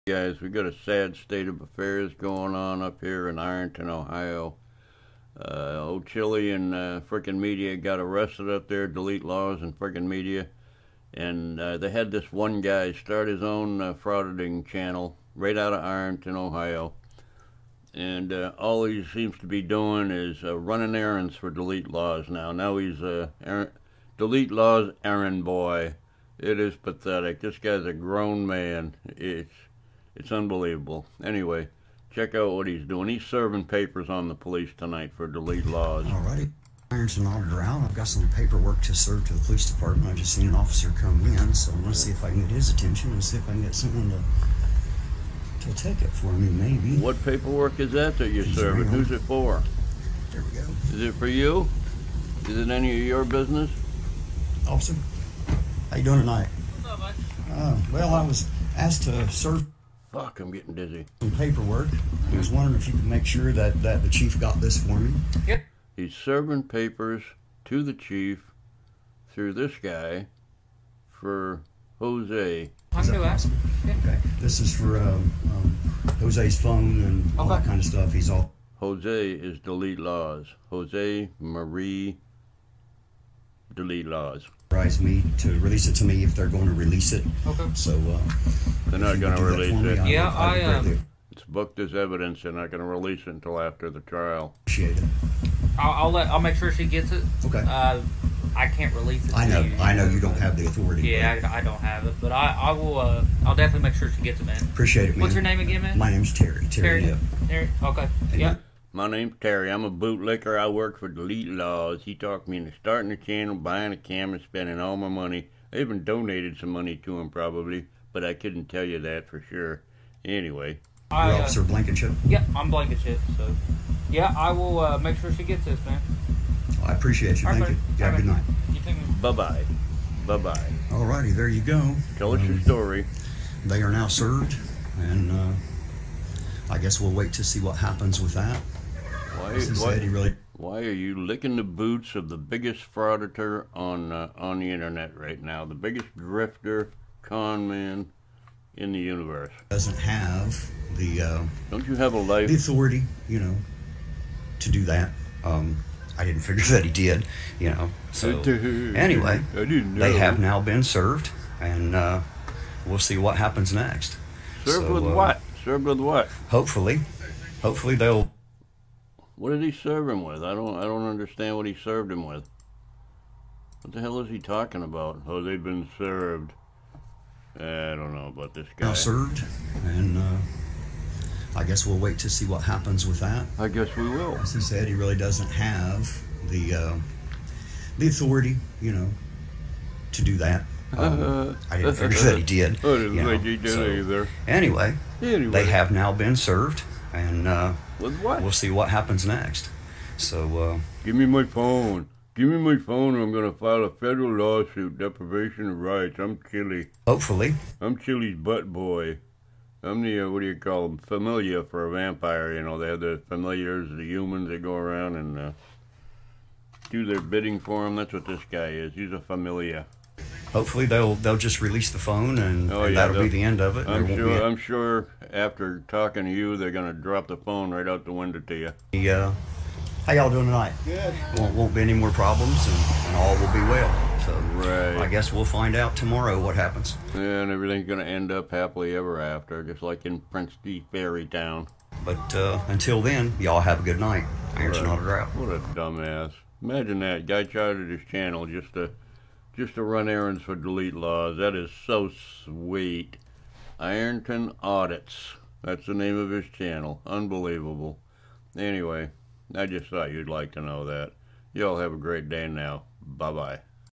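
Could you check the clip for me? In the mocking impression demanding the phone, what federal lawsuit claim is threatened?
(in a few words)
Deprivation of rights.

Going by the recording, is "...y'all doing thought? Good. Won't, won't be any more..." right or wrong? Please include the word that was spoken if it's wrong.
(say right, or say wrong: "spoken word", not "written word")
wrong: "tonight", not "thought".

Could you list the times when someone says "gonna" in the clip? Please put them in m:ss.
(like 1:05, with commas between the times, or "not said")
0:41, 3:46, 3:57.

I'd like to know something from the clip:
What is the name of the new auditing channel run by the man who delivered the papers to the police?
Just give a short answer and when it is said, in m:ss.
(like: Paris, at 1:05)
Ironton Audits, at 4:13.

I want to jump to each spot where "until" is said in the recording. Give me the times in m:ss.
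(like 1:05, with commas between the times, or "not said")
1:33, 4:02.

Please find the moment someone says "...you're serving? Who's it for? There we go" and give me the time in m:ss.
0:48.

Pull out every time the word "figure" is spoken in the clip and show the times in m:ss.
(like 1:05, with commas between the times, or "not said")
2:36, 3:11.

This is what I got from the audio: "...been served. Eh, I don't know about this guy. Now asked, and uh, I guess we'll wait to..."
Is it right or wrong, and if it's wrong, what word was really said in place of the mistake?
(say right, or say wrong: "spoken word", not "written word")
wrong: "served", not "asked".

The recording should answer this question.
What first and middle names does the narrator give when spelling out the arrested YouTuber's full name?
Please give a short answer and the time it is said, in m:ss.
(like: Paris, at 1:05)
Jose Maria, at 1:20.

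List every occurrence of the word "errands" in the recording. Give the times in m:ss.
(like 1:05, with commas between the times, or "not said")
0:20, 0:25, 4:10.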